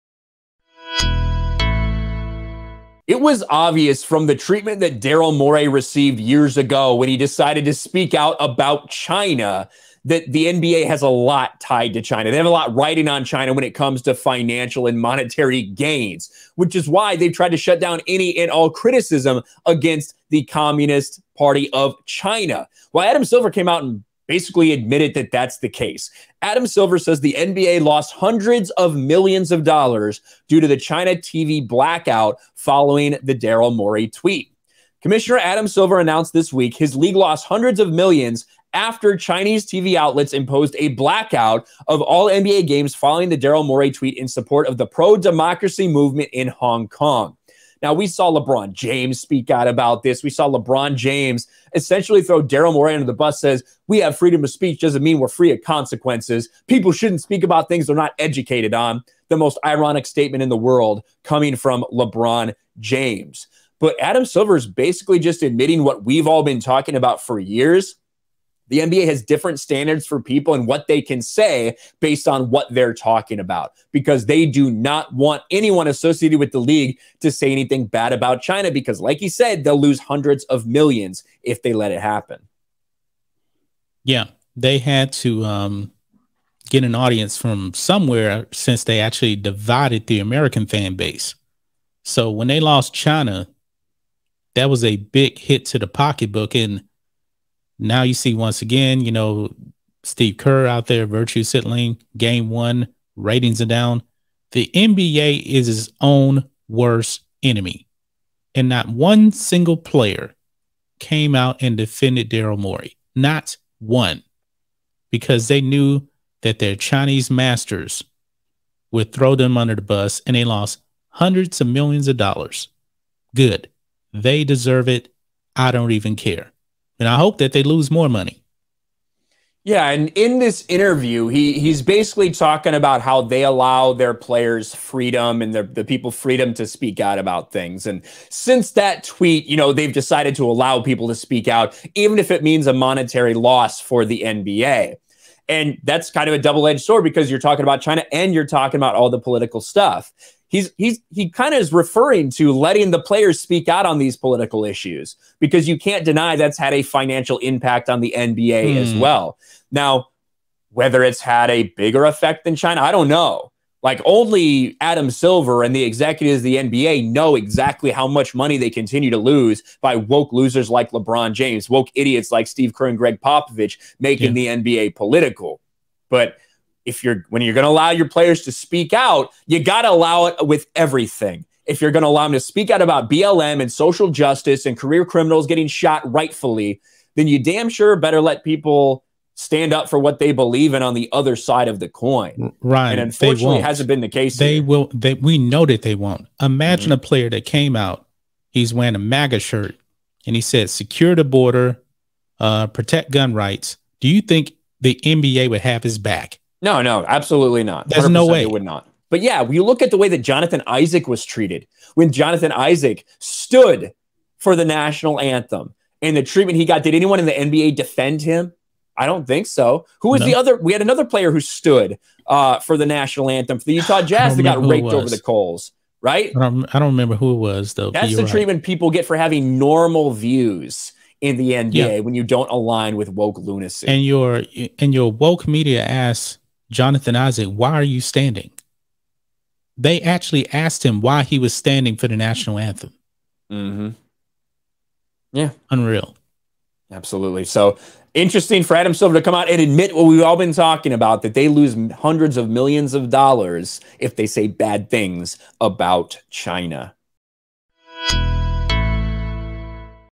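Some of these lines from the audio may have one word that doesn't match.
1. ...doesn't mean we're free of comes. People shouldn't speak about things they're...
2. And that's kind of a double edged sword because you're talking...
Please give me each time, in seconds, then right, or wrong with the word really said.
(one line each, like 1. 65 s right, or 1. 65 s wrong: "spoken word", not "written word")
1. 54 s wrong: "consequences", not "comes"
2. 145 s right.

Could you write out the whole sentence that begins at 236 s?
Jonathan Isaac, why are you standing?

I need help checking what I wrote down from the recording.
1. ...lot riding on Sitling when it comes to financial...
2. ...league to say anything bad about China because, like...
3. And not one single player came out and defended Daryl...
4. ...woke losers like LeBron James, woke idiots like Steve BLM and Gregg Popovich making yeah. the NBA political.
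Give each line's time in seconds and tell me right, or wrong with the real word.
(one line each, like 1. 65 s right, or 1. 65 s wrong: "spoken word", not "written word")
1. 12 s wrong: "China", not "Sitling"
2. 76 s right
3. 108 s right
4. 169 s wrong: "Kerr", not "BLM".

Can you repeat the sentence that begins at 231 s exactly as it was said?
when you don't align with woke lunacy.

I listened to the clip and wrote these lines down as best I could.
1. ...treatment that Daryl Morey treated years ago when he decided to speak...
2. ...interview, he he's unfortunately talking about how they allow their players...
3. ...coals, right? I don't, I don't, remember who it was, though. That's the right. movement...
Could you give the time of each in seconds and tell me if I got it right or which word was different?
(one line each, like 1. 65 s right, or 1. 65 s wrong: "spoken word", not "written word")
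1. 4 s wrong: "received", not "treated"
2. 130 s wrong: "basically", not "unfortunately"
3. 225 s wrong: "treatment", not "movement".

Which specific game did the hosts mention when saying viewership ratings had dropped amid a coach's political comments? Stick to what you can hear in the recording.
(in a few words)
game one.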